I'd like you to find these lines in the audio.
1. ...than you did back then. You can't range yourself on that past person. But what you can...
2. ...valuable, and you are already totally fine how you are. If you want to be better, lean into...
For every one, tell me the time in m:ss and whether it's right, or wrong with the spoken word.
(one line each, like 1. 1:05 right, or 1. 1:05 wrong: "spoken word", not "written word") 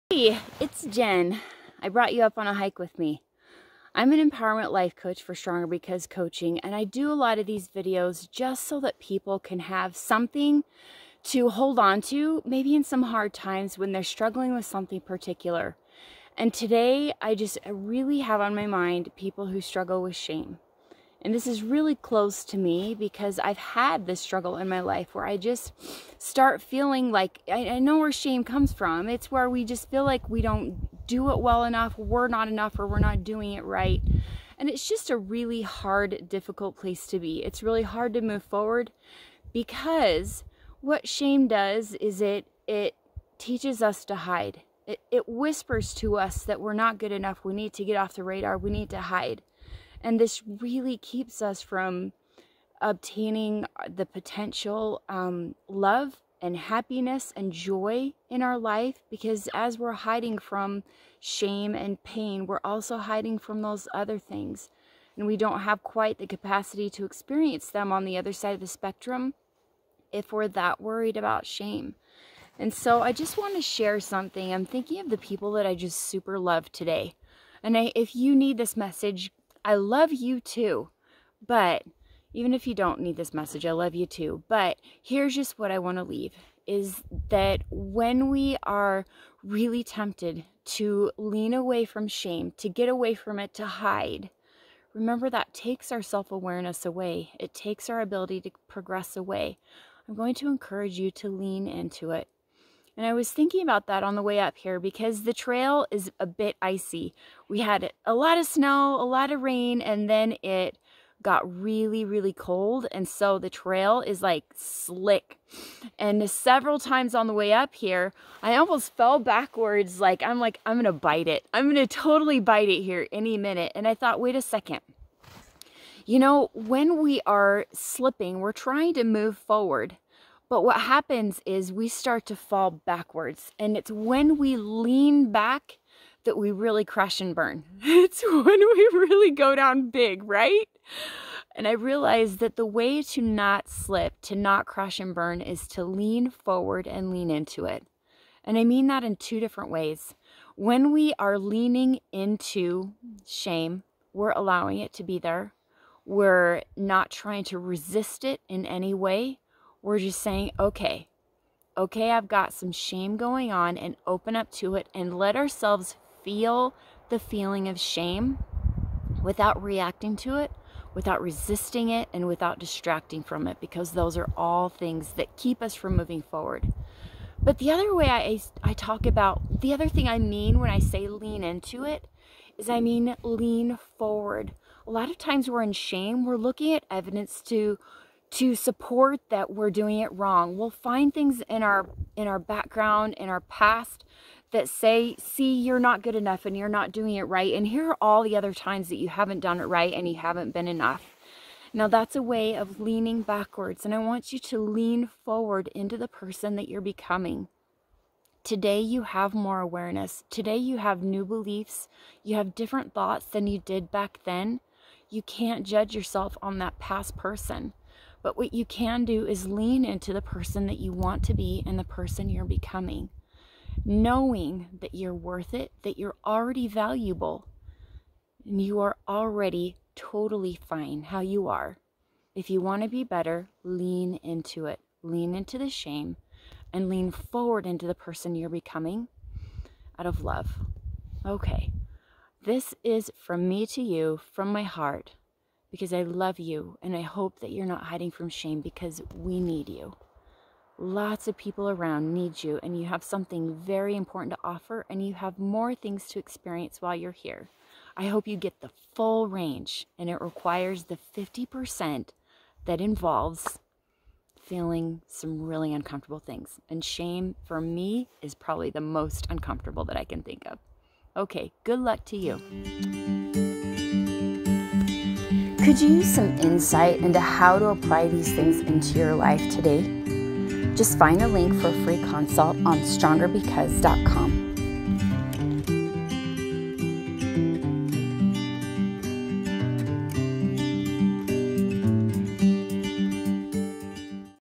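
1. 3:33 wrong: "judge", not "range"
2. 3:46 right.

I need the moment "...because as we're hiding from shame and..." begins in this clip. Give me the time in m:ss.
0:59.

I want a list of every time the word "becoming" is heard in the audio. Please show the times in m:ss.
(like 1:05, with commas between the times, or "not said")
3:26, 3:42, 3:58.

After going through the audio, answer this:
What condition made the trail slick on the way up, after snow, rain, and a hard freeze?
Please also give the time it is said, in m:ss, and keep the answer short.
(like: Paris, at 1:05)
Icy, at 1:46.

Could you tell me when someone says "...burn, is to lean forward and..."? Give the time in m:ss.
2:25.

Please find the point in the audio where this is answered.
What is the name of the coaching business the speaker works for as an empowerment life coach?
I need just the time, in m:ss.
0:05.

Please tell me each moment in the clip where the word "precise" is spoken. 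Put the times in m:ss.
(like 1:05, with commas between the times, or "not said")
not said.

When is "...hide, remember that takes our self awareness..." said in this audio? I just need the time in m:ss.
1:33.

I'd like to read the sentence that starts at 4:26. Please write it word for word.
And shame for me is probably the most uncomfortable that I can think of.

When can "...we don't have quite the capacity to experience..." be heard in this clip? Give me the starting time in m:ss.
1:05.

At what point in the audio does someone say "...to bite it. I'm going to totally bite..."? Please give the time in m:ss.
2:00.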